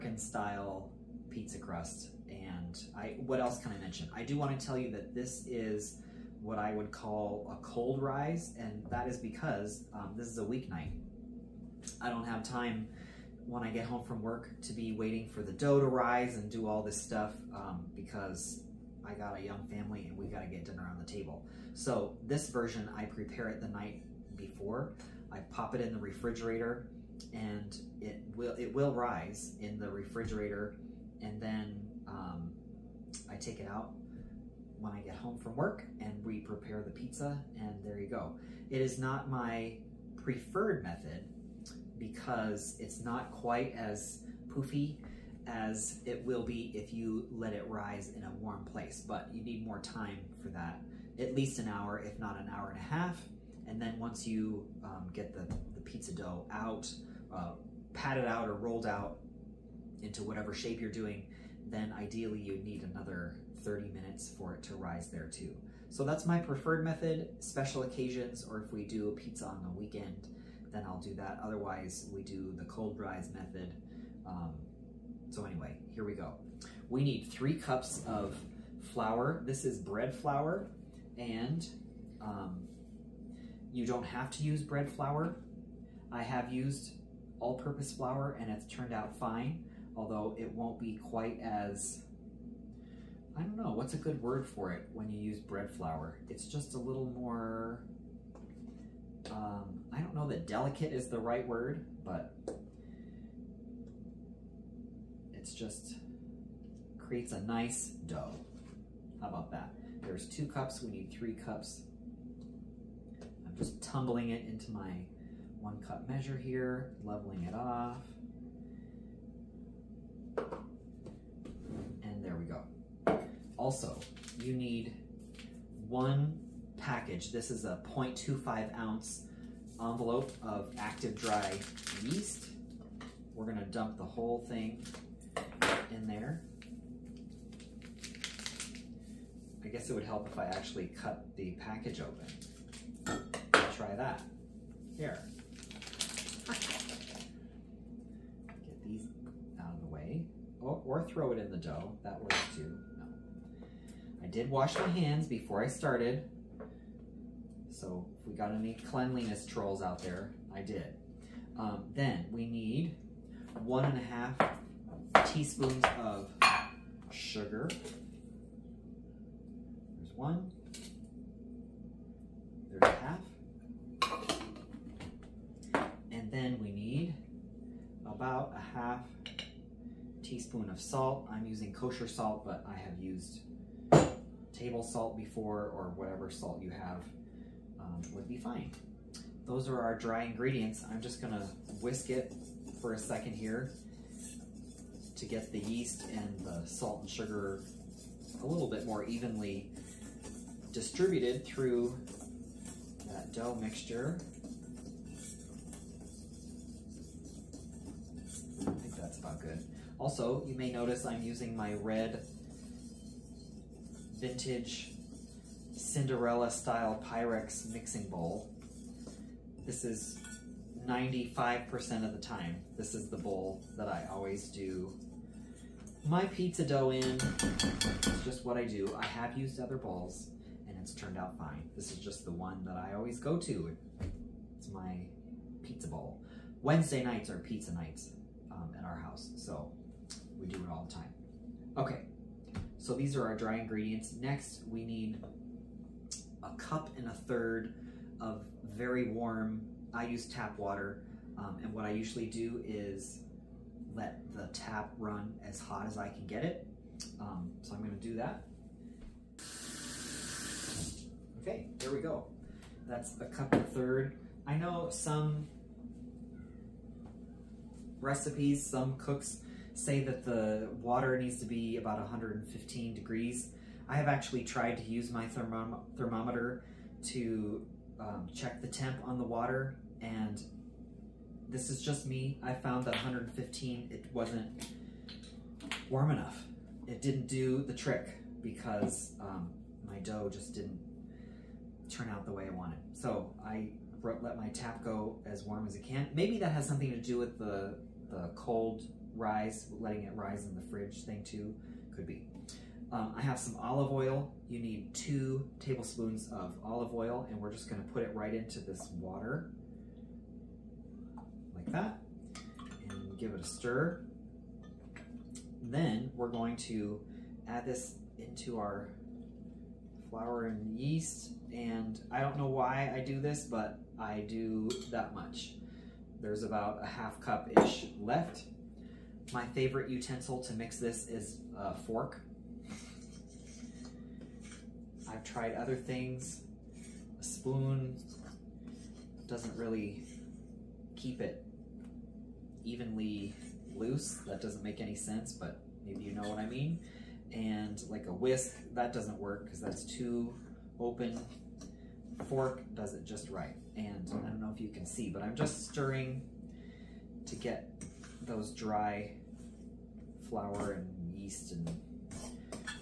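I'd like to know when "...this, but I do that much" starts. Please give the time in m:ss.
5:23.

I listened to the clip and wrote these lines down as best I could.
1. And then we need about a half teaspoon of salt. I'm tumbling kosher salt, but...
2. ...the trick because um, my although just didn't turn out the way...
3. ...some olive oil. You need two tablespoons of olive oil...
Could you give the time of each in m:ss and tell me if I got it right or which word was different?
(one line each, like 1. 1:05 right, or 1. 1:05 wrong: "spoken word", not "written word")
1. 2:56 wrong: "using", not "tumbling"
2. 4:47 wrong: "dough", not "although"
3. 5:03 right.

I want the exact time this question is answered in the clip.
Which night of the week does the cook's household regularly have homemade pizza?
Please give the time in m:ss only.
3:56.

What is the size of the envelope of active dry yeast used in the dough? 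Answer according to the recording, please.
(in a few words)
0.25 ounce.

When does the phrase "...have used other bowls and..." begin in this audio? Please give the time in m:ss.
3:49.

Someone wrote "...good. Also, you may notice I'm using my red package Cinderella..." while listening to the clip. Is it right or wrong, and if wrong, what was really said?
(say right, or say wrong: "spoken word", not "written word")
wrong: "vintage", not "package".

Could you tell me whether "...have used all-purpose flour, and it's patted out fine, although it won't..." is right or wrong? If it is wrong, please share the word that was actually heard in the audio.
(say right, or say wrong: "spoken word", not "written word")
wrong: "turned", not "patted".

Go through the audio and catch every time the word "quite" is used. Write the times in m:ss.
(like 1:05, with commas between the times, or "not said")
0:43, 1:31.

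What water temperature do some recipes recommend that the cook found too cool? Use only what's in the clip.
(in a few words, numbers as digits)
115 degrees.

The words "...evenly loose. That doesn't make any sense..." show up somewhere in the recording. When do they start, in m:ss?
5:42.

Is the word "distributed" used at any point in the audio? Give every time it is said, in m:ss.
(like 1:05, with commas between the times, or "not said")
3:20.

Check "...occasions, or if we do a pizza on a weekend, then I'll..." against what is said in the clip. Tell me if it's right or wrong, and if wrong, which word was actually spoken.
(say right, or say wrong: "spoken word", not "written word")
right.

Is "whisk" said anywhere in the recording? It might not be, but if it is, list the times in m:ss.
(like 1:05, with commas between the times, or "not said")
3:11, 5:48.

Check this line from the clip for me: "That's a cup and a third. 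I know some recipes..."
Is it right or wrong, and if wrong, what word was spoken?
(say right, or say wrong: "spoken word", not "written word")
right.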